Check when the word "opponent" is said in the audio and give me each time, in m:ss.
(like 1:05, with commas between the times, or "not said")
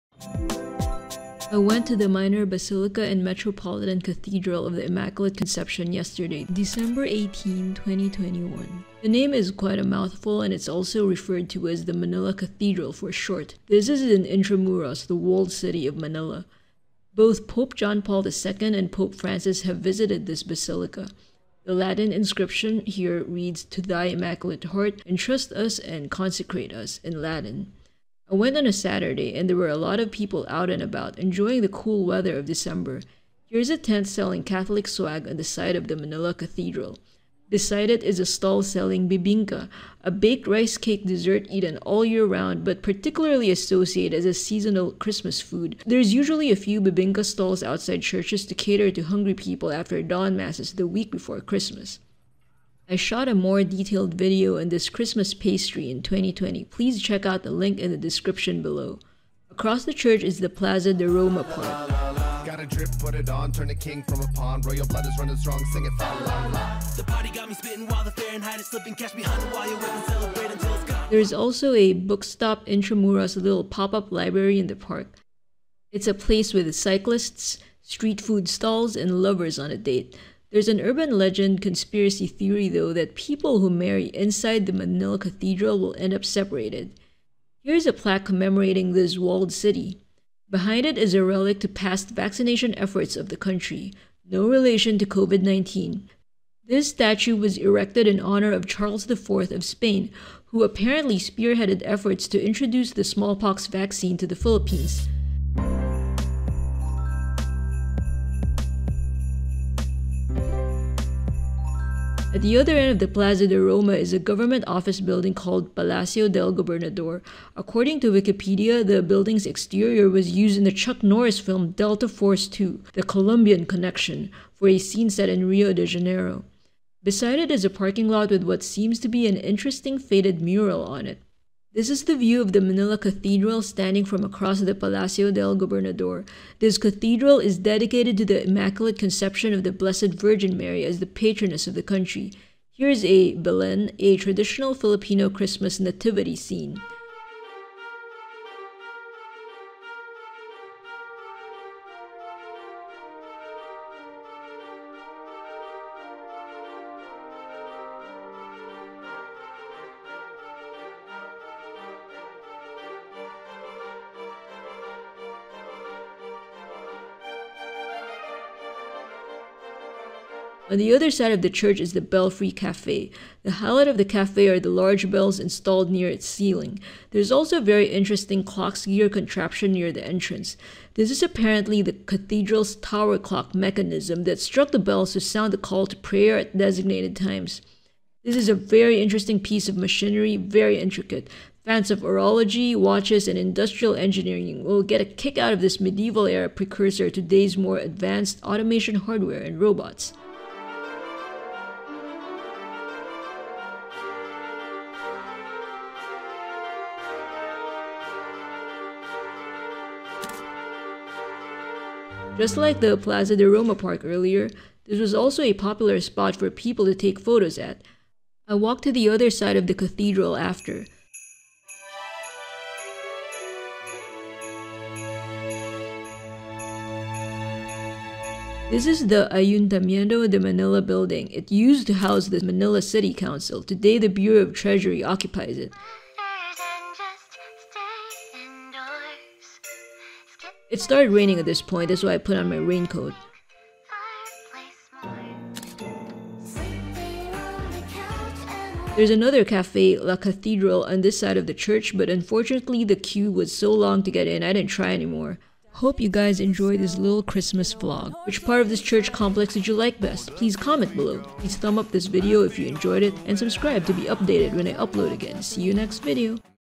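not said.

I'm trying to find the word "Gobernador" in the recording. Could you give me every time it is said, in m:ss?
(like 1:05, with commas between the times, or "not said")
1:56, 2:15.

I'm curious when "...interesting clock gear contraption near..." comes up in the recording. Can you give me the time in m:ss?
2:57.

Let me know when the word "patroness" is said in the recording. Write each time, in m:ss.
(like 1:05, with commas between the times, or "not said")
2:21.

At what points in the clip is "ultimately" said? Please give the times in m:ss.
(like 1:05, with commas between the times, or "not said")
not said.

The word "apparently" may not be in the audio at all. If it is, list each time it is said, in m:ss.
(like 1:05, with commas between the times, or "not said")
1:40, 3:01.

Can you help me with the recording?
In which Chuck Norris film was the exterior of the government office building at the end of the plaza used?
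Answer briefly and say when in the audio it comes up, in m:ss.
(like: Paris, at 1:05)
Delta Force 2, at 2:01.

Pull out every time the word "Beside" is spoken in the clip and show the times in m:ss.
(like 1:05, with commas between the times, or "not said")
0:37, 2:07.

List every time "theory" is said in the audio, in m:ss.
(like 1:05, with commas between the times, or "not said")
1:22.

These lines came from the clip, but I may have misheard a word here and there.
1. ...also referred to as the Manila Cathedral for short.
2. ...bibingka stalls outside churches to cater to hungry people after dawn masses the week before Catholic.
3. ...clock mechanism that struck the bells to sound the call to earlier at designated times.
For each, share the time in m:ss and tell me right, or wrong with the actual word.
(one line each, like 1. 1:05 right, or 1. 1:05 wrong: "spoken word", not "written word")
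1. 0:10 right
2. 0:46 wrong: "Christmas", not "Catholic"
3. 3:03 wrong: "prayer", not "earlier".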